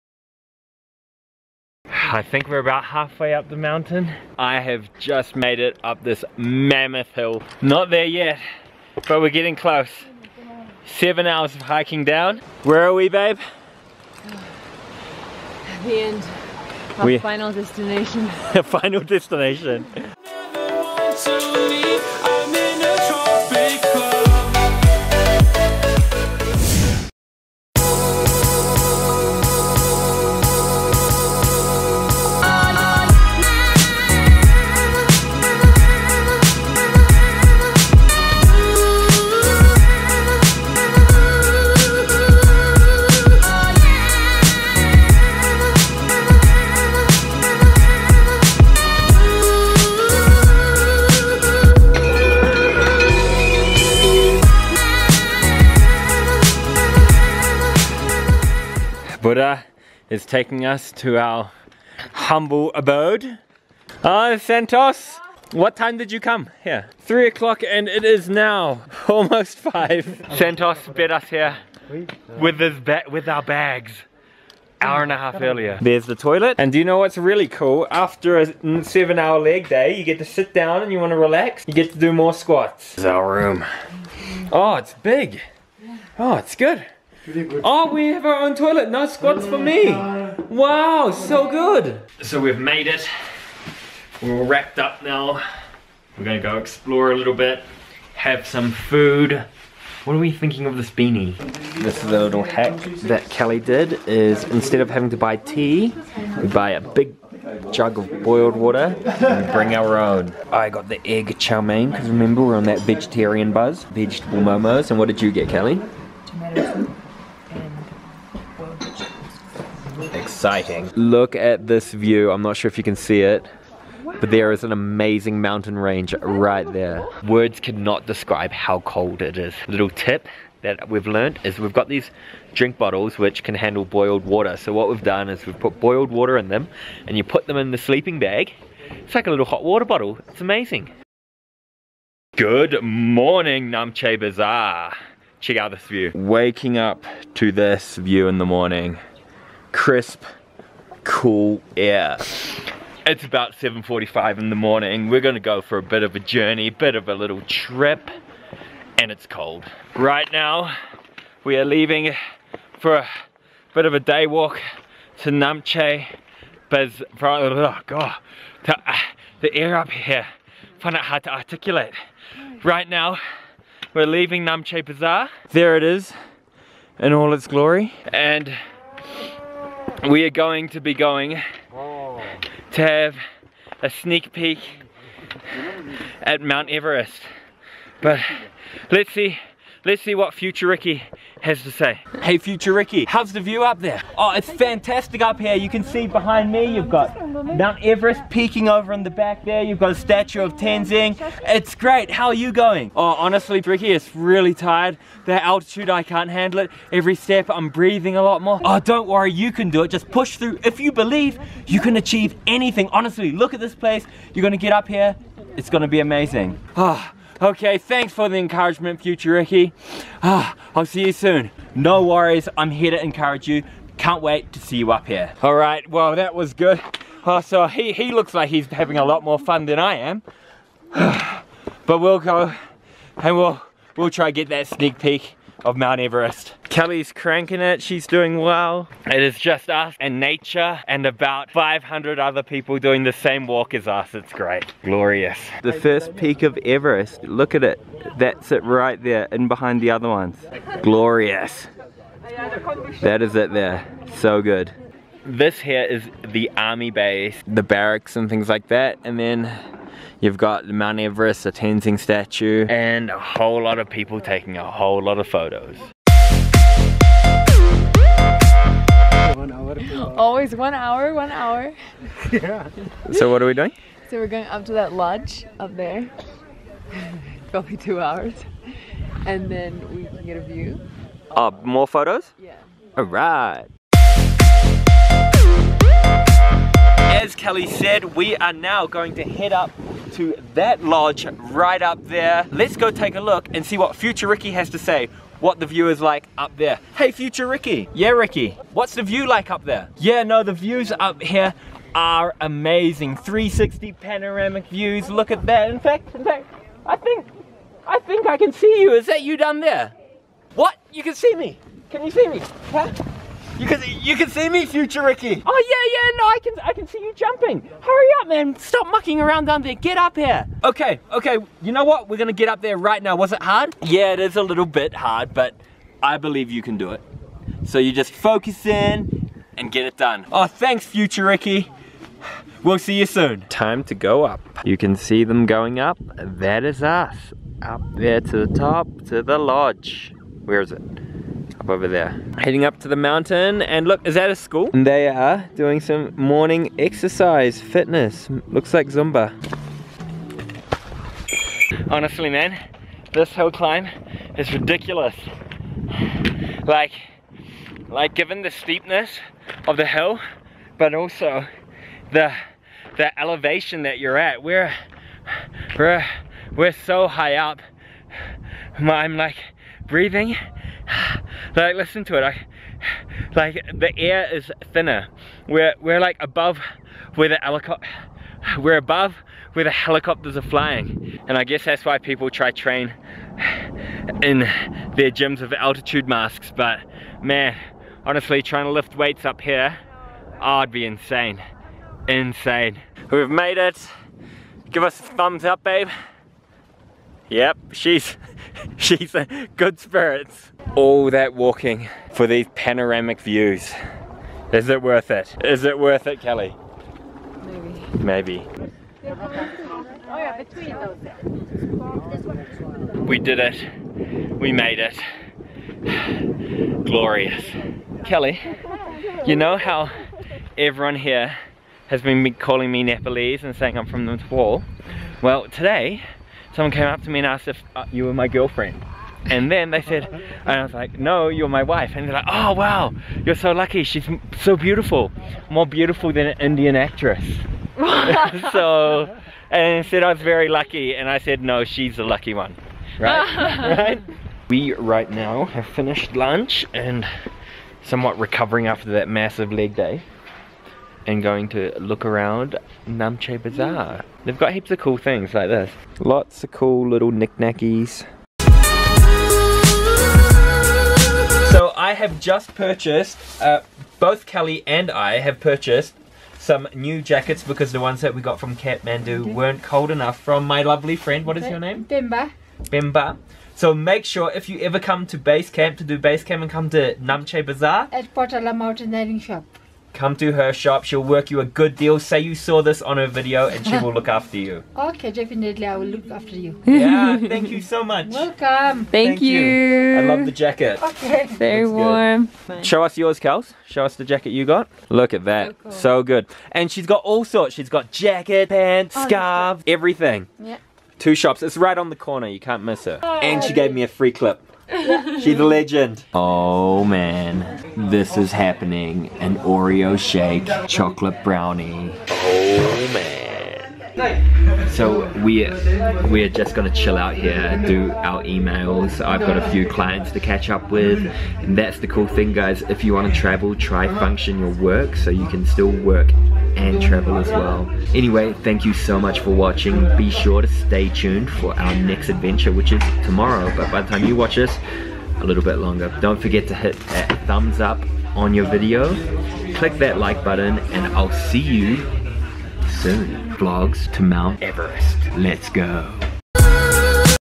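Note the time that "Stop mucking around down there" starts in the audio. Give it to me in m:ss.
5:18.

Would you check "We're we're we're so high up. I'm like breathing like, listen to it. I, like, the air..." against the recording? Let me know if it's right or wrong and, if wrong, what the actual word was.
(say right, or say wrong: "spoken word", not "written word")
right.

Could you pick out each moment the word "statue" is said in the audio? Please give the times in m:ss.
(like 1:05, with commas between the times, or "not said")
3:19, 4:21.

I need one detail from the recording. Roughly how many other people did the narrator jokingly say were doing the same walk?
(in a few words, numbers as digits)
500.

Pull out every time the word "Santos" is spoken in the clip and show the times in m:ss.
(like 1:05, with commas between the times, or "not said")
1:04, 1:10.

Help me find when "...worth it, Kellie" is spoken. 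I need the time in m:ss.
6:45.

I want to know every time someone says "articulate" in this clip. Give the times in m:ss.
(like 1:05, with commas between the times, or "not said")
2:51.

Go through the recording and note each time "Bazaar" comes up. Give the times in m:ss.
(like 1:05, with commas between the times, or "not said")
2:24, 2:54, 7:33, 7:57.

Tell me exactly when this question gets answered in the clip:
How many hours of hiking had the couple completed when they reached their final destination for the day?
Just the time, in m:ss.
0:10.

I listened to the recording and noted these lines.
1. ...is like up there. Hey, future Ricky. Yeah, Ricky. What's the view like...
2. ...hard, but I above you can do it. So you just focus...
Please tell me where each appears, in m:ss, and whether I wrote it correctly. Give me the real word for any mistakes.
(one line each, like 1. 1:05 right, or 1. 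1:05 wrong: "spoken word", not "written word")
1. 4:55 right
2. 5:24 wrong: "believe", not "above".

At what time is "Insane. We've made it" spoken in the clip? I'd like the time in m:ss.
6:32.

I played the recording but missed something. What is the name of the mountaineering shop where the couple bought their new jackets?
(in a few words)
Potala Mountaineering Shop.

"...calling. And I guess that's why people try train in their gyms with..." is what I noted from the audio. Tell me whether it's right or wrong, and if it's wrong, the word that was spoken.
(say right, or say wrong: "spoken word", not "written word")
wrong: "flying", not "calling".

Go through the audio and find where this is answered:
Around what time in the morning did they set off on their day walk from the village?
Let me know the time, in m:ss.
2:33.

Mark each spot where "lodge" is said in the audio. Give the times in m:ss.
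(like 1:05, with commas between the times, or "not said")
4:34, 4:50, 5:39.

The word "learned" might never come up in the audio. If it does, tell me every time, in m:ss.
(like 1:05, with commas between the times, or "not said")
2:11.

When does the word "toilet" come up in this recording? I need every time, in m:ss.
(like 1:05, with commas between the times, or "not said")
1:16, 1:28.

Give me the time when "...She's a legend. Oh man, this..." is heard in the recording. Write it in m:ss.
8:25.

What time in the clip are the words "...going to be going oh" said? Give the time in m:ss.
3:00.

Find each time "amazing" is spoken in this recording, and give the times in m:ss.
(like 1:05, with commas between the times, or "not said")
2:04, 2:20, 3:35, 5:02.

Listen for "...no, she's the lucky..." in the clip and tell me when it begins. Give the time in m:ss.
7:21.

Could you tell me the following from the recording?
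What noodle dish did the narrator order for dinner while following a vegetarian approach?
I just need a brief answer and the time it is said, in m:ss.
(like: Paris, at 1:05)
Egg chow mein, at 1:51.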